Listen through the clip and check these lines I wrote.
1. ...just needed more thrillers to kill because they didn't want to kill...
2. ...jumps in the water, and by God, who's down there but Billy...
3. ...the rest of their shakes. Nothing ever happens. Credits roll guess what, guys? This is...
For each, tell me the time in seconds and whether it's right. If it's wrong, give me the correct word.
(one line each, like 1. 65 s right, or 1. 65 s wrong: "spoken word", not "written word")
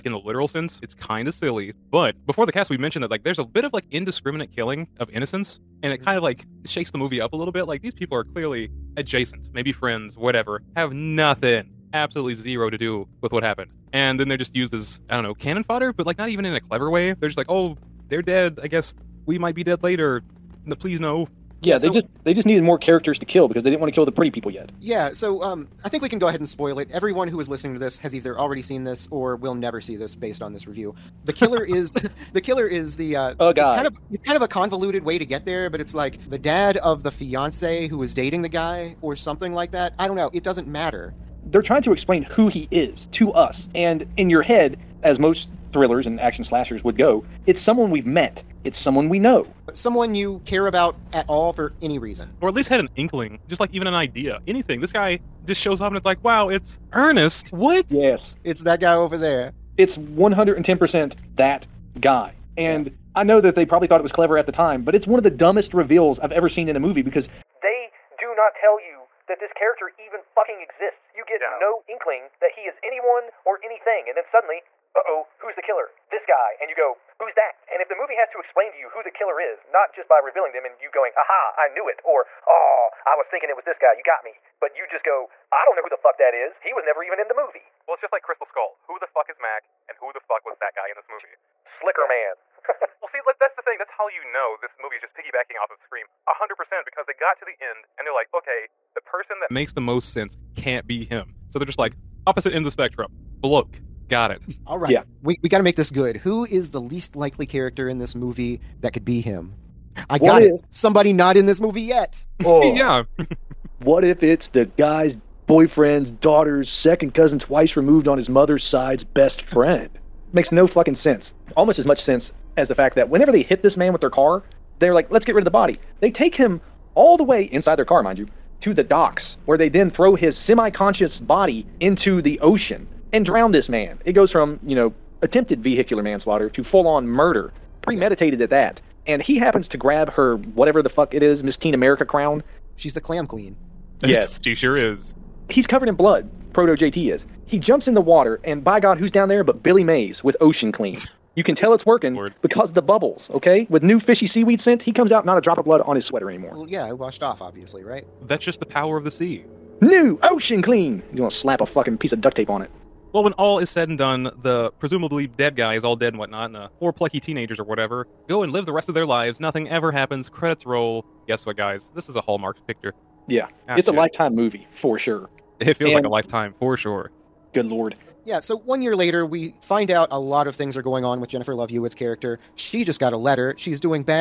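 1. 22 s wrong: "characters", not "thrillers"
2. 147 s right
3. 168 s wrong: "lives", not "shakes".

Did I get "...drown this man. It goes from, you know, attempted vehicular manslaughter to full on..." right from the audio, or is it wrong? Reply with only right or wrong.
right.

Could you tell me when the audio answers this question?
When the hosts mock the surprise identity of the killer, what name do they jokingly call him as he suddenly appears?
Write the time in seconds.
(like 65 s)
56 s.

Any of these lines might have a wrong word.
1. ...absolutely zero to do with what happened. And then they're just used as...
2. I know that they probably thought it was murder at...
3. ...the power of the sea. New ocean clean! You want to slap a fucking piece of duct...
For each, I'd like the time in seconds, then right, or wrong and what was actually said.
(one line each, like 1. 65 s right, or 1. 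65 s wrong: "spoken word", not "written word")
1. 11 s right
2. 63 s wrong: "clever", not "murder"
3. 158 s right.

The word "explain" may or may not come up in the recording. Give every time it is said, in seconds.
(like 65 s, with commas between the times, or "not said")
41 s, 78 s.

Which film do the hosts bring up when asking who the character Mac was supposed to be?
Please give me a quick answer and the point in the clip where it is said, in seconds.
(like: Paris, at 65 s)
Crystal Skull, at 88 s.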